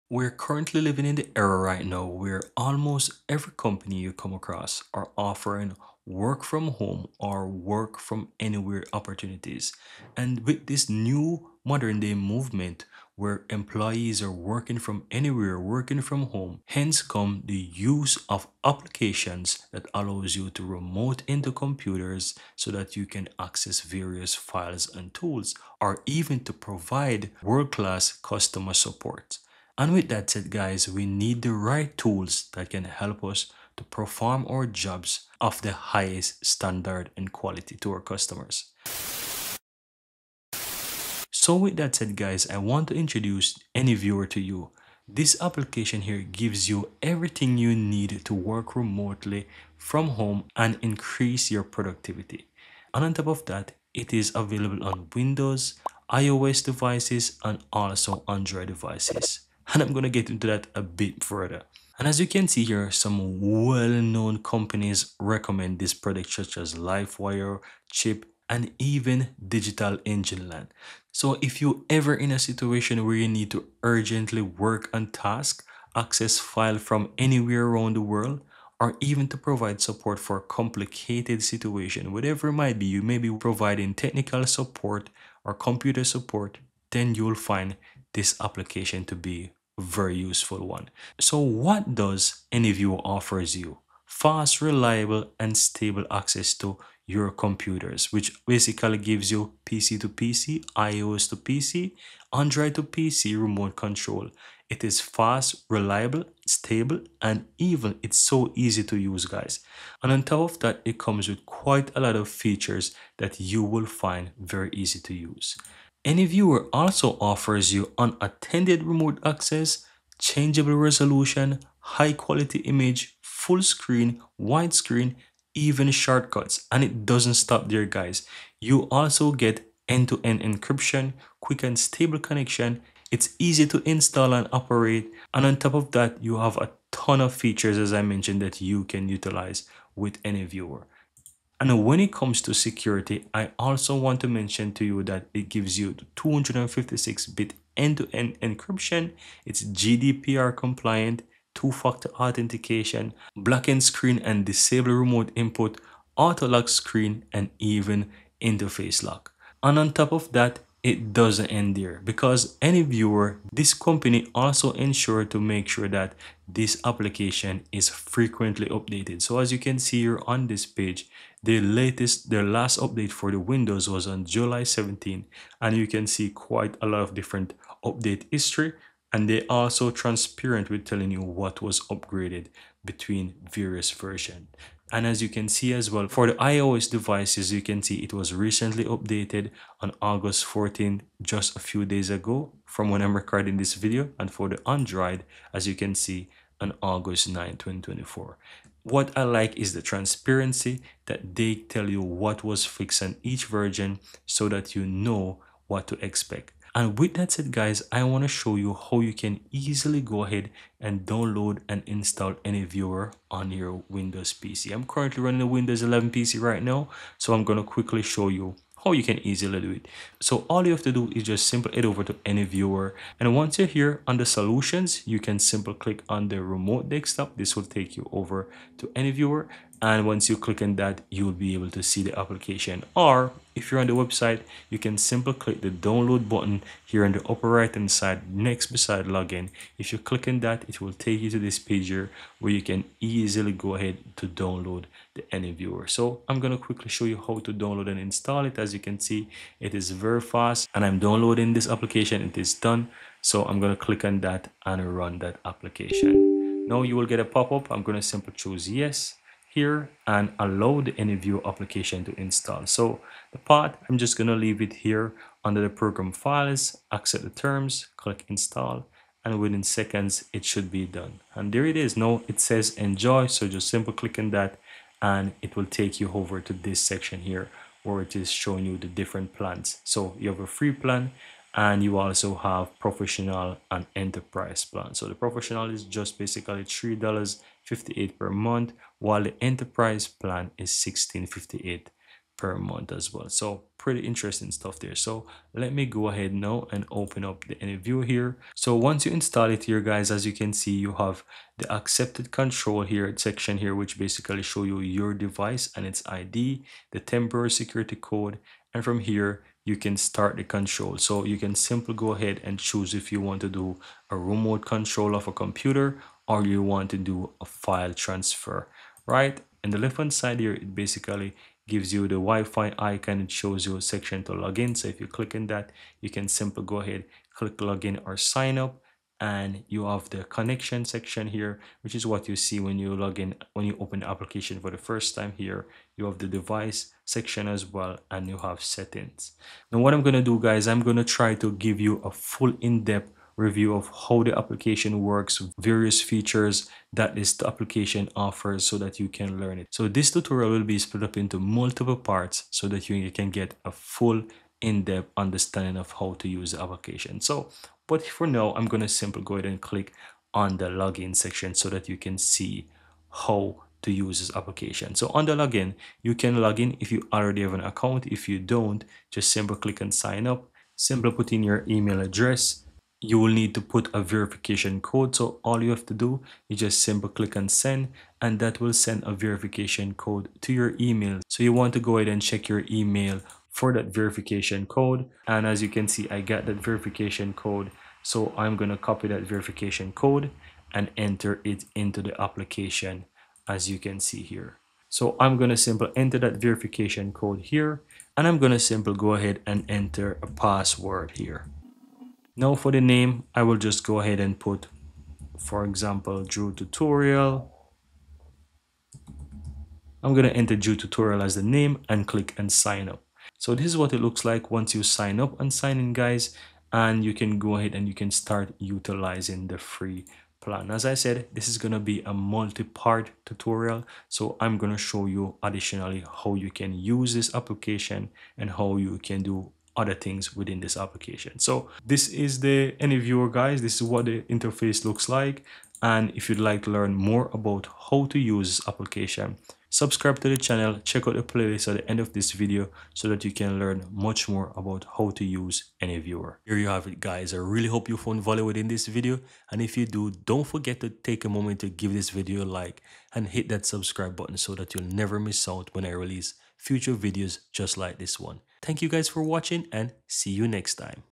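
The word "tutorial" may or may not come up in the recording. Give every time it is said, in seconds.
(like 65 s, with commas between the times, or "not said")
350 s, 406 s, 410 s, 423 s.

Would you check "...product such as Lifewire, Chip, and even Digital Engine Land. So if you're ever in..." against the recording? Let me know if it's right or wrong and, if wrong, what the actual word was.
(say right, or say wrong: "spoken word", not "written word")
right.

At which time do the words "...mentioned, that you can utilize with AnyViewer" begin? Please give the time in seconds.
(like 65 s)
138 s.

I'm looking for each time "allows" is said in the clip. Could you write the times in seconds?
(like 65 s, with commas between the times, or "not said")
19 s, 260 s.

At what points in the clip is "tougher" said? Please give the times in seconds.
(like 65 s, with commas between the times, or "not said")
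not said.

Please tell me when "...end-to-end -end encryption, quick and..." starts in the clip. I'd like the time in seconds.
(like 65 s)
129 s.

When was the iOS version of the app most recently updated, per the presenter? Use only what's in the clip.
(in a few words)
August 14.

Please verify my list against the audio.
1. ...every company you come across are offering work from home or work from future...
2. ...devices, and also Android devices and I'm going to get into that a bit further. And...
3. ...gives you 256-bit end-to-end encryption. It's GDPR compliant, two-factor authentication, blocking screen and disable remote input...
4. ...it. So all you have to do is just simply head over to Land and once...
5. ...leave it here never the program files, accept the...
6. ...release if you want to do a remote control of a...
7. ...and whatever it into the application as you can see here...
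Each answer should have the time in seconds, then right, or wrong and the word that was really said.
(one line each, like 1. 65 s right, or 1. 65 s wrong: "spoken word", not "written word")
1. 3 s wrong: "anywhere", not "future"
2. 56 s right
3. 145 s right
4. 219 s wrong: "AnyViewer", not "Land"
5. 264 s wrong: "under", not "never"
6. 312 s wrong: "choose", not "release"
7. 390 s wrong: "enter", not "whatever".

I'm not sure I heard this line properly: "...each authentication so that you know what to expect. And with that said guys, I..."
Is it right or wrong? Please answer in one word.
wrong.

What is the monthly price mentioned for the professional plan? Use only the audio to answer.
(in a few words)
$3.58.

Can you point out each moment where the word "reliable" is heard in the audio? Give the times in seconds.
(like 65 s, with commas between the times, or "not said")
94 s, 105 s.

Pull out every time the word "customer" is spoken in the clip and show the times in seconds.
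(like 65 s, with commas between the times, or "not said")
28 s, 37 s.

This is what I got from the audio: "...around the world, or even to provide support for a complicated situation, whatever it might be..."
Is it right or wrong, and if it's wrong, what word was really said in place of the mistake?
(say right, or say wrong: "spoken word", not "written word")
right.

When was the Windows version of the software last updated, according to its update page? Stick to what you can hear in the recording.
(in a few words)
July 17.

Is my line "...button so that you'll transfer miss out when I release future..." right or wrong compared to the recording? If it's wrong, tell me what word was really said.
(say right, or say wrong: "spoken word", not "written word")
wrong: "never", not "transfer".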